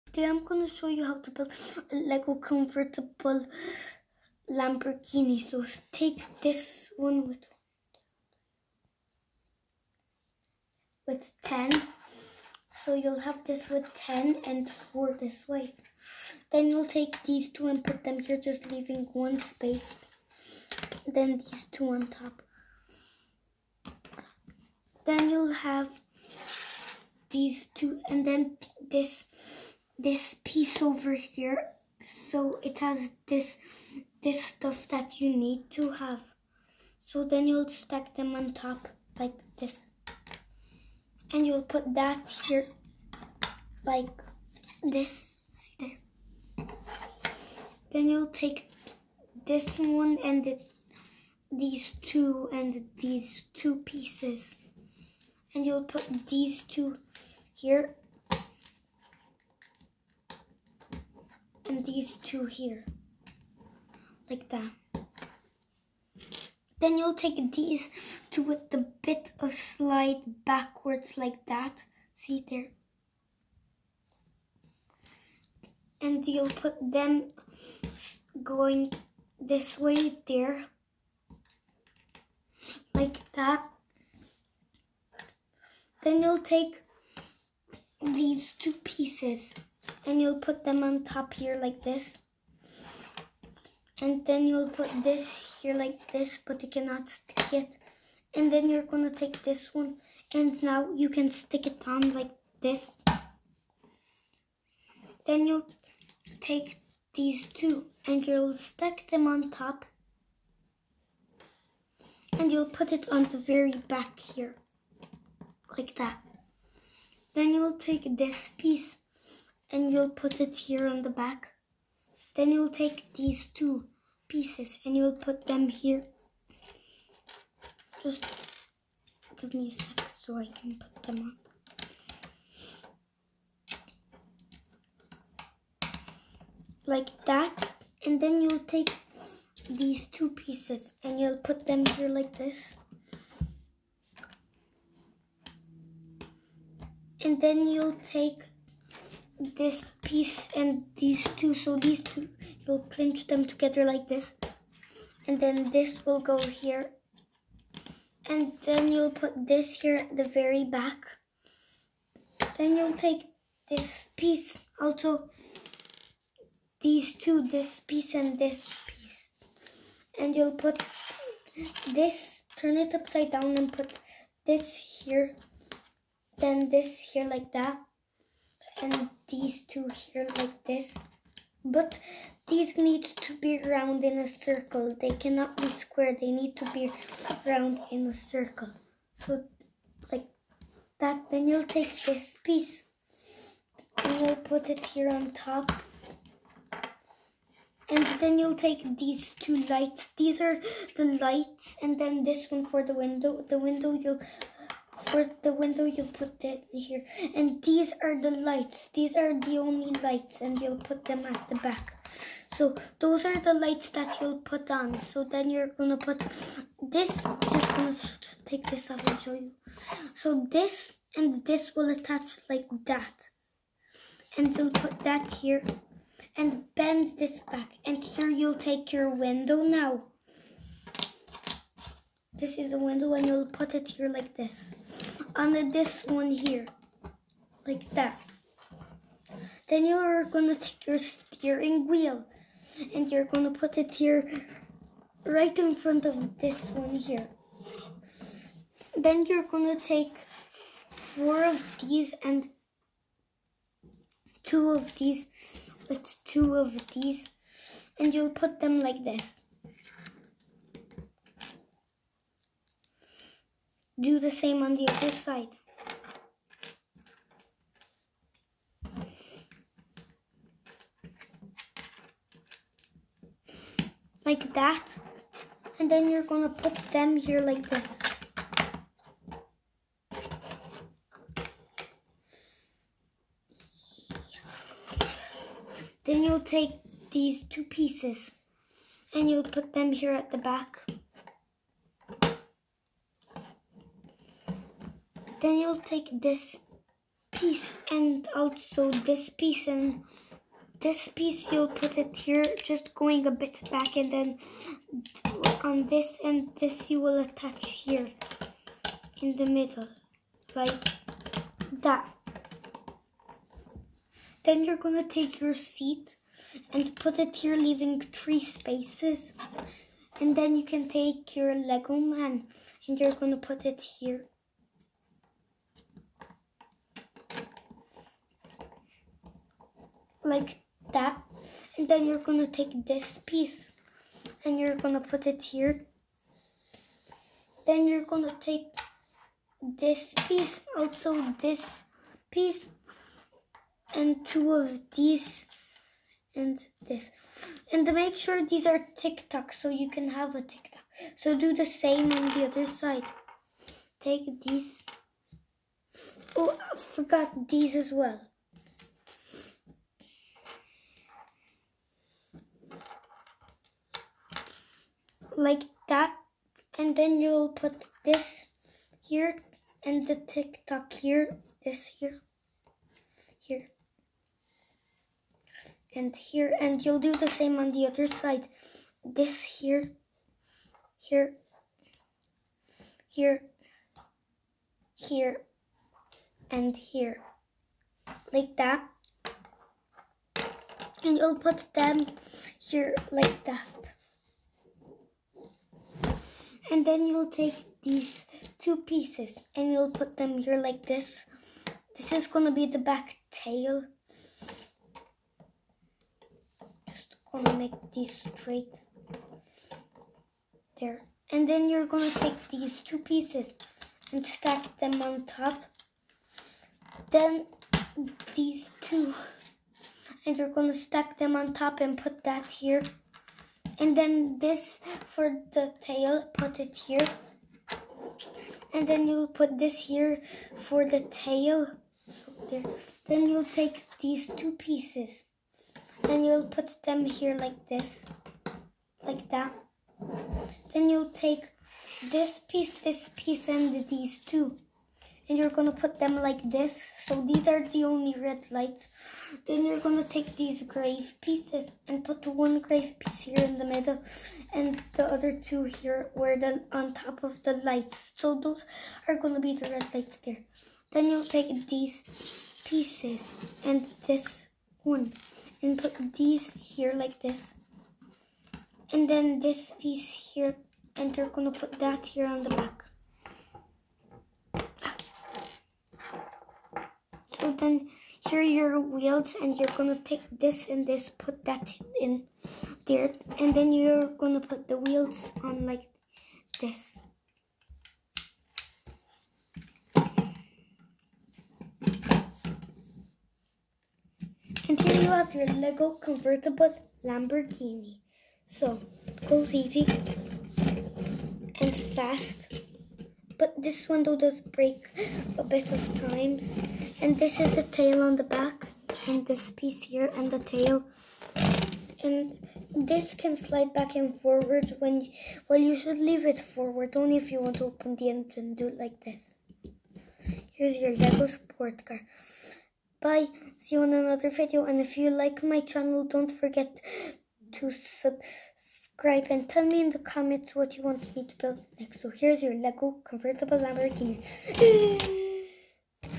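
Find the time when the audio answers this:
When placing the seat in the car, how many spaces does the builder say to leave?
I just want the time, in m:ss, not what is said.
5:17.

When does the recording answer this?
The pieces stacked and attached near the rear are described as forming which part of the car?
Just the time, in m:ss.
6:42.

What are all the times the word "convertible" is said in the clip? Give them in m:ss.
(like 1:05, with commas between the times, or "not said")
8:16, 8:53.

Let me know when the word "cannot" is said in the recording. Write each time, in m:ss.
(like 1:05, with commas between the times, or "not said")
1:36, 3:05.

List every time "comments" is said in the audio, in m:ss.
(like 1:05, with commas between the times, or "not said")
8:49.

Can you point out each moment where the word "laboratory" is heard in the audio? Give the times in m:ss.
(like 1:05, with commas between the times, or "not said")
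not said.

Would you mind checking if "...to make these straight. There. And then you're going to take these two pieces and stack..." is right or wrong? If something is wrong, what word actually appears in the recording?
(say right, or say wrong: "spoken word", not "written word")
right.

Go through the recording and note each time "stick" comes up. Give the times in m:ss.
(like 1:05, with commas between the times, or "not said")
1:37, 1:41.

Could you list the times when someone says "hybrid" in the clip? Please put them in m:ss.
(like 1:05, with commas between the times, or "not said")
not said.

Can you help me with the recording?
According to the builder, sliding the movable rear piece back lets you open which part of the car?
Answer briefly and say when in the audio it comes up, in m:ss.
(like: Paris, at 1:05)
the engine, at 8:37.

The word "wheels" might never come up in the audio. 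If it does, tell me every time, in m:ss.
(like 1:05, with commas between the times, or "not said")
4:01, 7:58, 8:04.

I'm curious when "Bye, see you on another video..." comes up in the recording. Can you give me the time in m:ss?
8:43.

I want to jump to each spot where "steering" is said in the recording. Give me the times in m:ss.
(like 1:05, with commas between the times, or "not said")
4:00.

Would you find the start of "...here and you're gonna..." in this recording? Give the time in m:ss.
7:50.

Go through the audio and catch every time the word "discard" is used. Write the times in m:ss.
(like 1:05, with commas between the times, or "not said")
not said.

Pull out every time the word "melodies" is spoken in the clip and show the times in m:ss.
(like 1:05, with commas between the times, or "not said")
not said.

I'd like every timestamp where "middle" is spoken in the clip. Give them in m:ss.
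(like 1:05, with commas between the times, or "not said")
5:09, 7:33.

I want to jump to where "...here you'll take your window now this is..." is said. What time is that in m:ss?
3:48.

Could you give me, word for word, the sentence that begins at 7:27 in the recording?
So these are the only red lights.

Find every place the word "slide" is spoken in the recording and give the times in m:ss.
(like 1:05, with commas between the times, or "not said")
1:09, 8:33.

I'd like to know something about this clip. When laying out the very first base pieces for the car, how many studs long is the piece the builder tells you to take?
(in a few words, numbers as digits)
10.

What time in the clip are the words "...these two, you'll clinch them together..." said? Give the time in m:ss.
2:31.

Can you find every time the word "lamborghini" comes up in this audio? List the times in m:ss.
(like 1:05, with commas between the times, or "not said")
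0:04, 8:17, 8:53.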